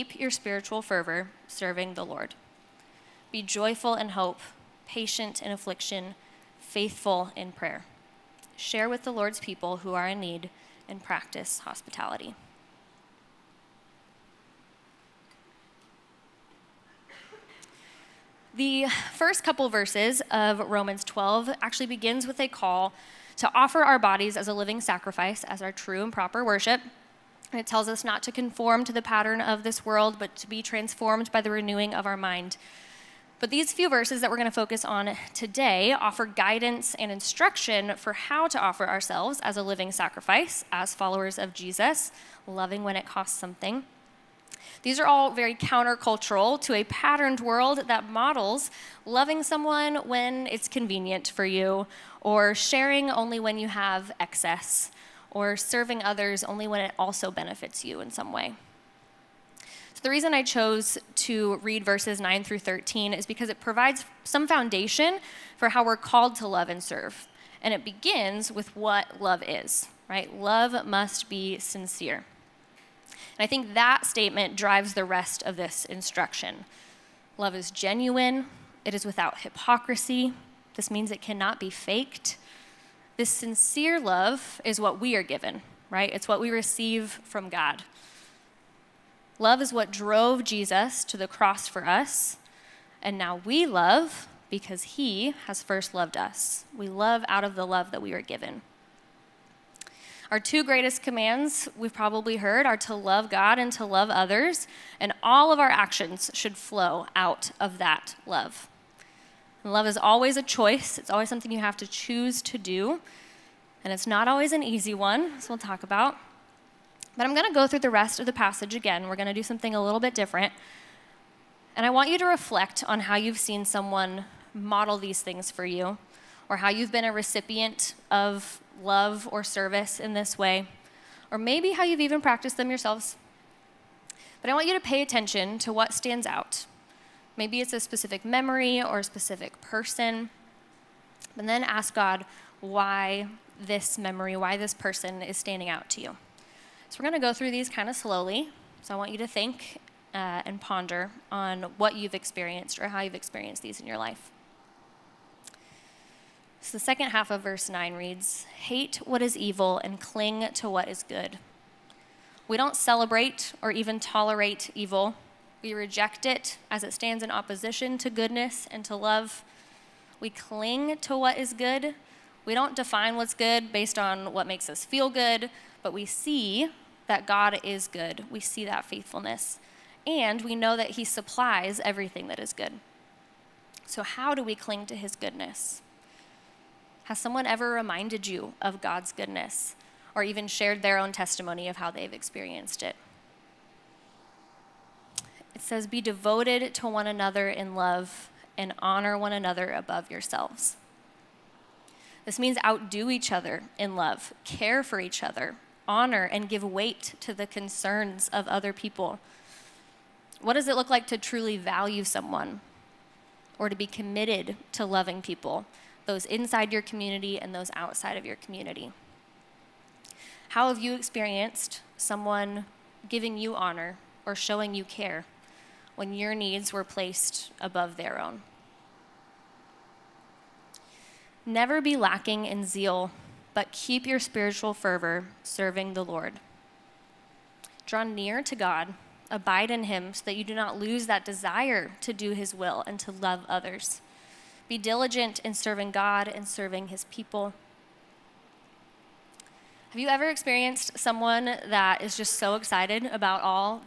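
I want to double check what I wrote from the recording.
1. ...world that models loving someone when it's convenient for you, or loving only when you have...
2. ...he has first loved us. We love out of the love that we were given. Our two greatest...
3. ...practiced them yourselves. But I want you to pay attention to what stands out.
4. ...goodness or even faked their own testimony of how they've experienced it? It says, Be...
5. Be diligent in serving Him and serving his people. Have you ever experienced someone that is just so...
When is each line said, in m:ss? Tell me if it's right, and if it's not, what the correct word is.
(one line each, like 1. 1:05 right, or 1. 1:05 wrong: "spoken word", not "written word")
1. 0:47 wrong: "sharing", not "loving"
2. 1:34 right
3. 2:12 right
4. 3:09 wrong: "shared", not "faked"
5. 4:04 wrong: "God", not "Him".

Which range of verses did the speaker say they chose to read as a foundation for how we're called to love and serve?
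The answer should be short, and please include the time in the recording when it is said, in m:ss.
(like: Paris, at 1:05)
9 through 13, at 1:01.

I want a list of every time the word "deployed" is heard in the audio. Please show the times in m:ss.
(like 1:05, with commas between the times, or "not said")
not said.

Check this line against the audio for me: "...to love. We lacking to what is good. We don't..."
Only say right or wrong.
wrong.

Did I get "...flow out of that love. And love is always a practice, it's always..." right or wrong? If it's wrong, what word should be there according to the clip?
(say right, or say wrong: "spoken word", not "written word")
wrong: "choice", not "practice".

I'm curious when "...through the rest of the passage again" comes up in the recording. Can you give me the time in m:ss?
1:57.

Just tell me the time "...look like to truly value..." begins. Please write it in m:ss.
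3:30.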